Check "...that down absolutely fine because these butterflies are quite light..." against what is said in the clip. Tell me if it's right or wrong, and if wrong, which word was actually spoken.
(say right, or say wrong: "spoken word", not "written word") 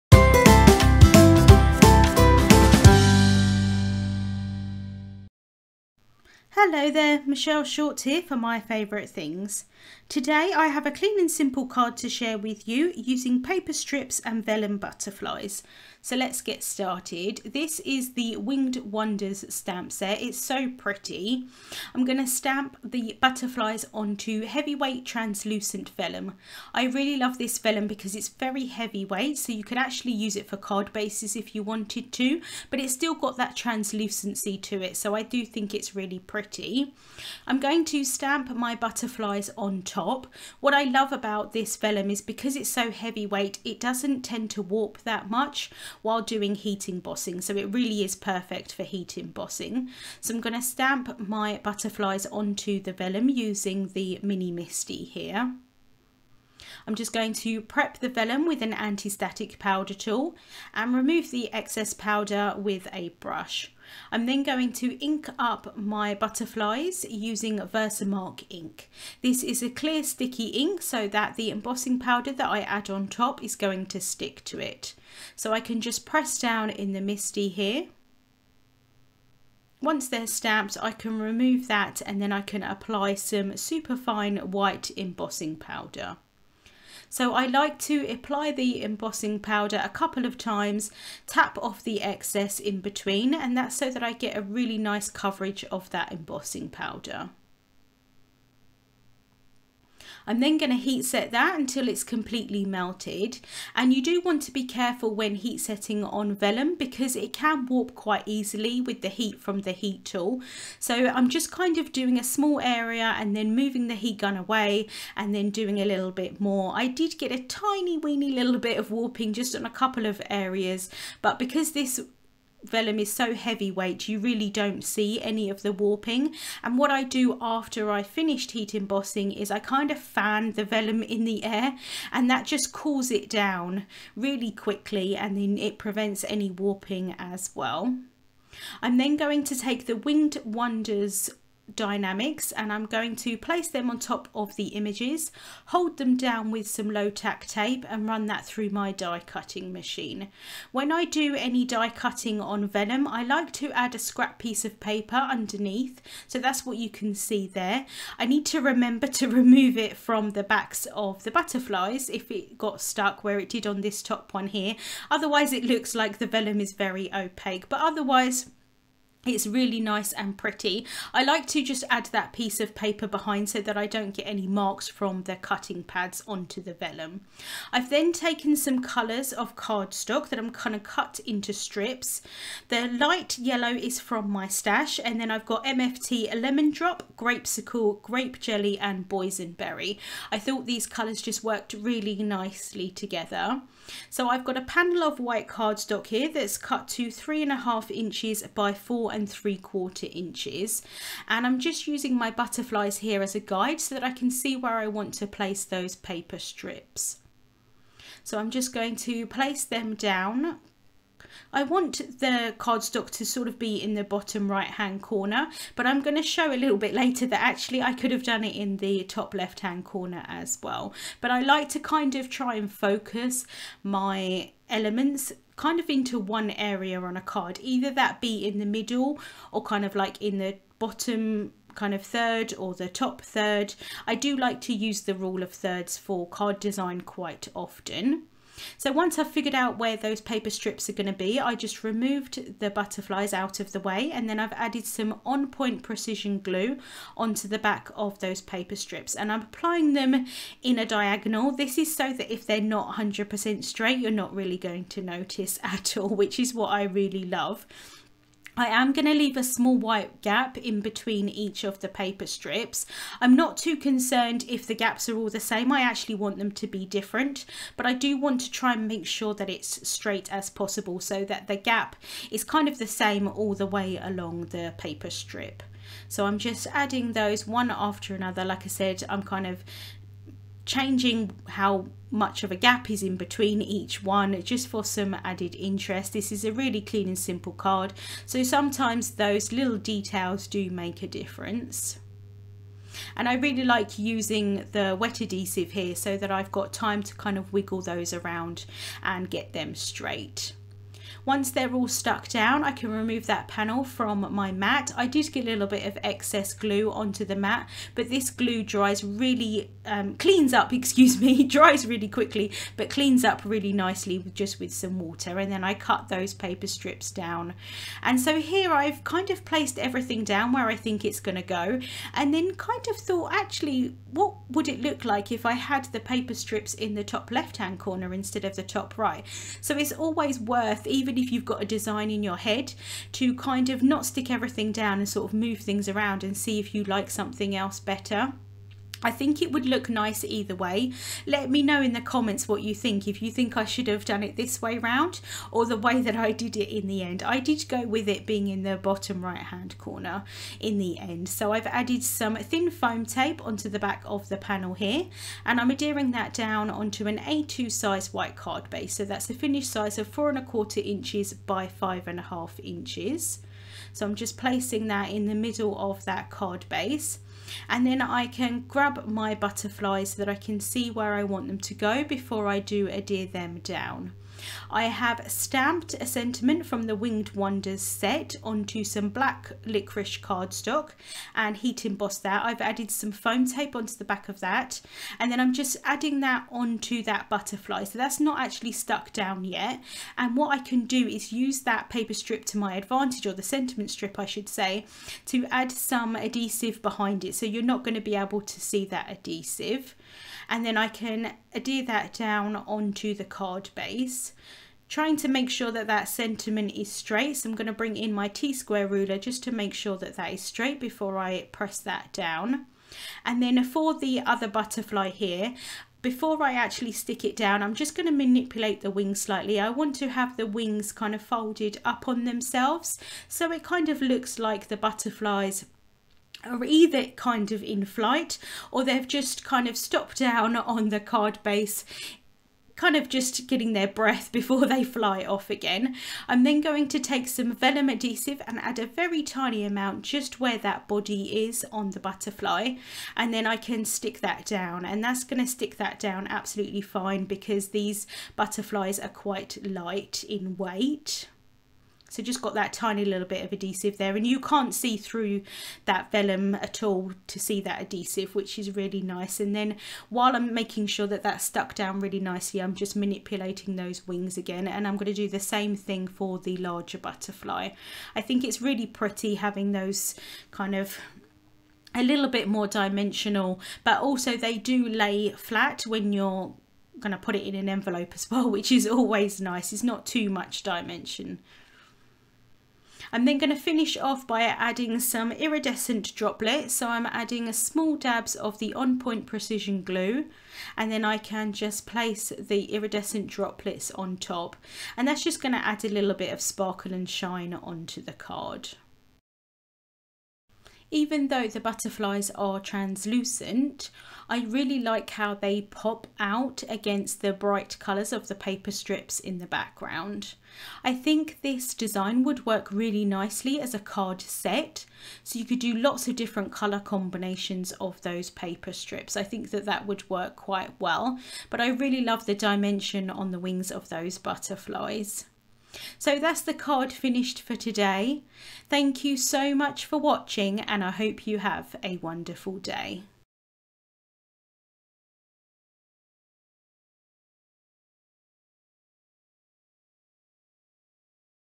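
right.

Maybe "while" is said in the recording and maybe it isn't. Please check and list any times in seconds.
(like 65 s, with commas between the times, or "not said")
46 s, 460 s.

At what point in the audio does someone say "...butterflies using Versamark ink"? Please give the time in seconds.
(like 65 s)
66 s.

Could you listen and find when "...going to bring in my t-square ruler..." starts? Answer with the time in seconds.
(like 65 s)
407 s.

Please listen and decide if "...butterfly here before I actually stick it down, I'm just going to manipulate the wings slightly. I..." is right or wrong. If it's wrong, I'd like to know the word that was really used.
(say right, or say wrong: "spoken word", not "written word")
right.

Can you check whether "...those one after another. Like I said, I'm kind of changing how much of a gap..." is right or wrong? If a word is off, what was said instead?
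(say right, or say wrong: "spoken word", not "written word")
right.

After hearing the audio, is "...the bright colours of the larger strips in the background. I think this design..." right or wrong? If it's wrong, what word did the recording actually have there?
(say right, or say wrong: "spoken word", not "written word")
wrong: "paper", not "larger".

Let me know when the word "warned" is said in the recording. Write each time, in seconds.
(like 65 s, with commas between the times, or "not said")
not said.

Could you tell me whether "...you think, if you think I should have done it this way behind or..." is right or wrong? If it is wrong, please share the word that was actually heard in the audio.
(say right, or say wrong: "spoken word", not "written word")
wrong: "round", not "behind".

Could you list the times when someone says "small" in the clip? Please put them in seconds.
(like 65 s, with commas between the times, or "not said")
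112 s, 259 s, 487 s.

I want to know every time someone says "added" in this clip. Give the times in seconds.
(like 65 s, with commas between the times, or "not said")
244 s, 285 s, 351 s, 382 s.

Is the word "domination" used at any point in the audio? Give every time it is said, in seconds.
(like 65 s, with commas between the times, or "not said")
not said.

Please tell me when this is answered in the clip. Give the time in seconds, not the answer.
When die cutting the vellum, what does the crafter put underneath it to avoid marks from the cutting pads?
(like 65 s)
153 s.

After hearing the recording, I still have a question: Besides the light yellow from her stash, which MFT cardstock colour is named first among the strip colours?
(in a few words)
lemon drop.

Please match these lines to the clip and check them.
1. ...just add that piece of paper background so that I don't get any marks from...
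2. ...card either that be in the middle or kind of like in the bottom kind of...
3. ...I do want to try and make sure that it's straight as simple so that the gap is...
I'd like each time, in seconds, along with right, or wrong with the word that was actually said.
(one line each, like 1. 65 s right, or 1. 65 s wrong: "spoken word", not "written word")
1. 171 s wrong: "behind", not "background"
2. 227 s right
3. 267 s wrong: "possible", not "simple".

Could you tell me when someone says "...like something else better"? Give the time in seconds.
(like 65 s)
336 s.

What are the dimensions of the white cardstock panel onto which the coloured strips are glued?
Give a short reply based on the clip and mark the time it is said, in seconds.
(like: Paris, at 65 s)
3.5 by 4.75 inches, at 197 s.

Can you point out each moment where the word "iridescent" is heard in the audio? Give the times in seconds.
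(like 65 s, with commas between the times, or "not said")
485 s, 492 s.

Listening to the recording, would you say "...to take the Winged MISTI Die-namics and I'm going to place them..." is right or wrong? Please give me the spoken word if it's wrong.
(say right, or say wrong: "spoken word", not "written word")
wrong: "Wonders", not "MISTI".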